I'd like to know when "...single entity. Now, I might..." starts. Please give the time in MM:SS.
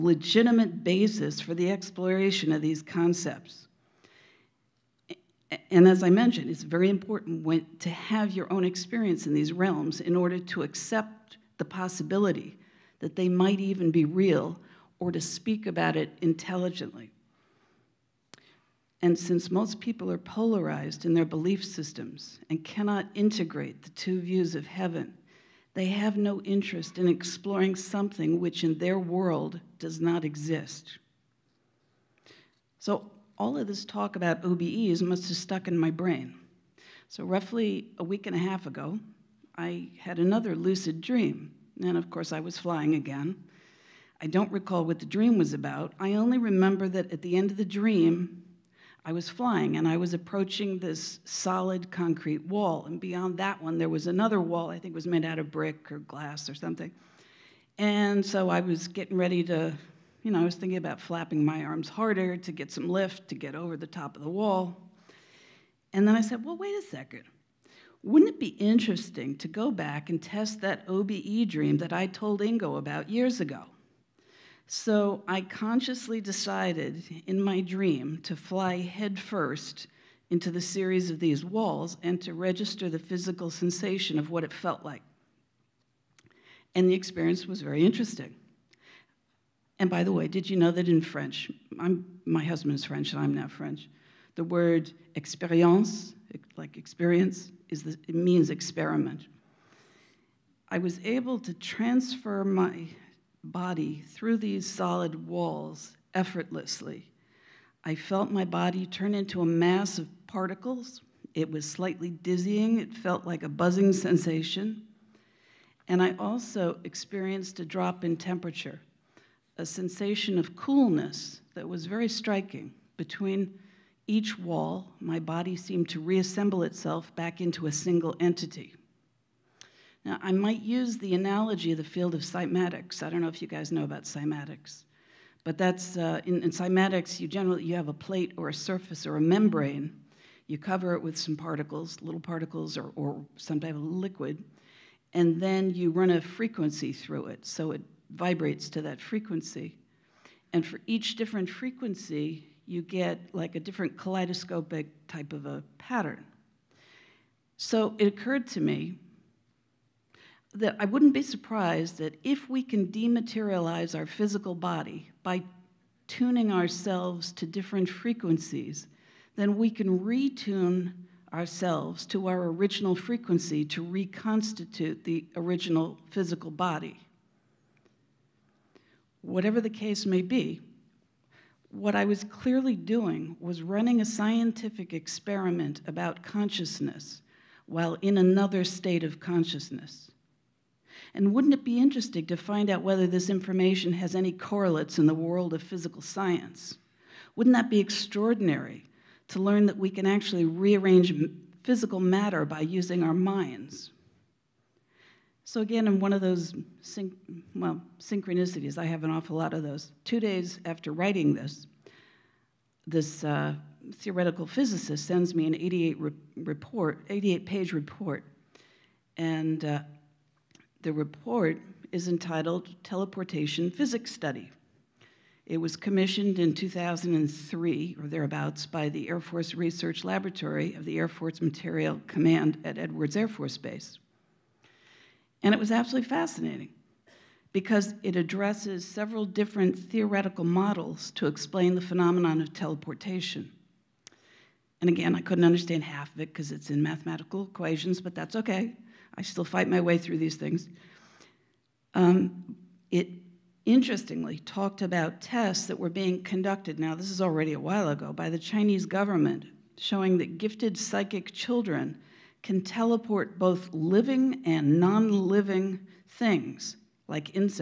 02:07.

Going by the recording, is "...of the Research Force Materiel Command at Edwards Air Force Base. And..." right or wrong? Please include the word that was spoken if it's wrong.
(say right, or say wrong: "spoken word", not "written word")
wrong: "Air", not "Research".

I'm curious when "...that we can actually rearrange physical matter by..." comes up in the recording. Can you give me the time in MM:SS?
03:19.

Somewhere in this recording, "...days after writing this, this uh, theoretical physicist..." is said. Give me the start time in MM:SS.
03:30.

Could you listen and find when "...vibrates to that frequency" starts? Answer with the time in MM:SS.
02:28.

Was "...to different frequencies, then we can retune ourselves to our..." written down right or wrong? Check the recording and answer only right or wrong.
right.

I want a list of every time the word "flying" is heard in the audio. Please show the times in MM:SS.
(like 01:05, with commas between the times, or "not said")
00:42, 00:49.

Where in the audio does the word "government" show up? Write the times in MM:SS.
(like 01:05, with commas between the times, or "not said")
04:18.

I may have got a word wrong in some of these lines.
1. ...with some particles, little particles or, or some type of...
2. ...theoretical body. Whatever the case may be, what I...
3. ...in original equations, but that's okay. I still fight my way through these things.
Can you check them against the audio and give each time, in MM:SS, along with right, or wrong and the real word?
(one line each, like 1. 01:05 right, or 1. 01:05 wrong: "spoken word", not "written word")
1. 02:21 right
2. 02:56 wrong: "physical", not "theoretical"
3. 04:06 wrong: "mathematical", not "original".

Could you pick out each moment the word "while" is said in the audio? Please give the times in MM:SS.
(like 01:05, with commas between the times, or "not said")
03:07, 04:17.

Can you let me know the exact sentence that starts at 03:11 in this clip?
And wouldn't it be interesting to find out whether this information has any correlates in the world of physical science?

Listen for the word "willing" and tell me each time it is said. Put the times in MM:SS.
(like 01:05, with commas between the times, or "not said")
not said.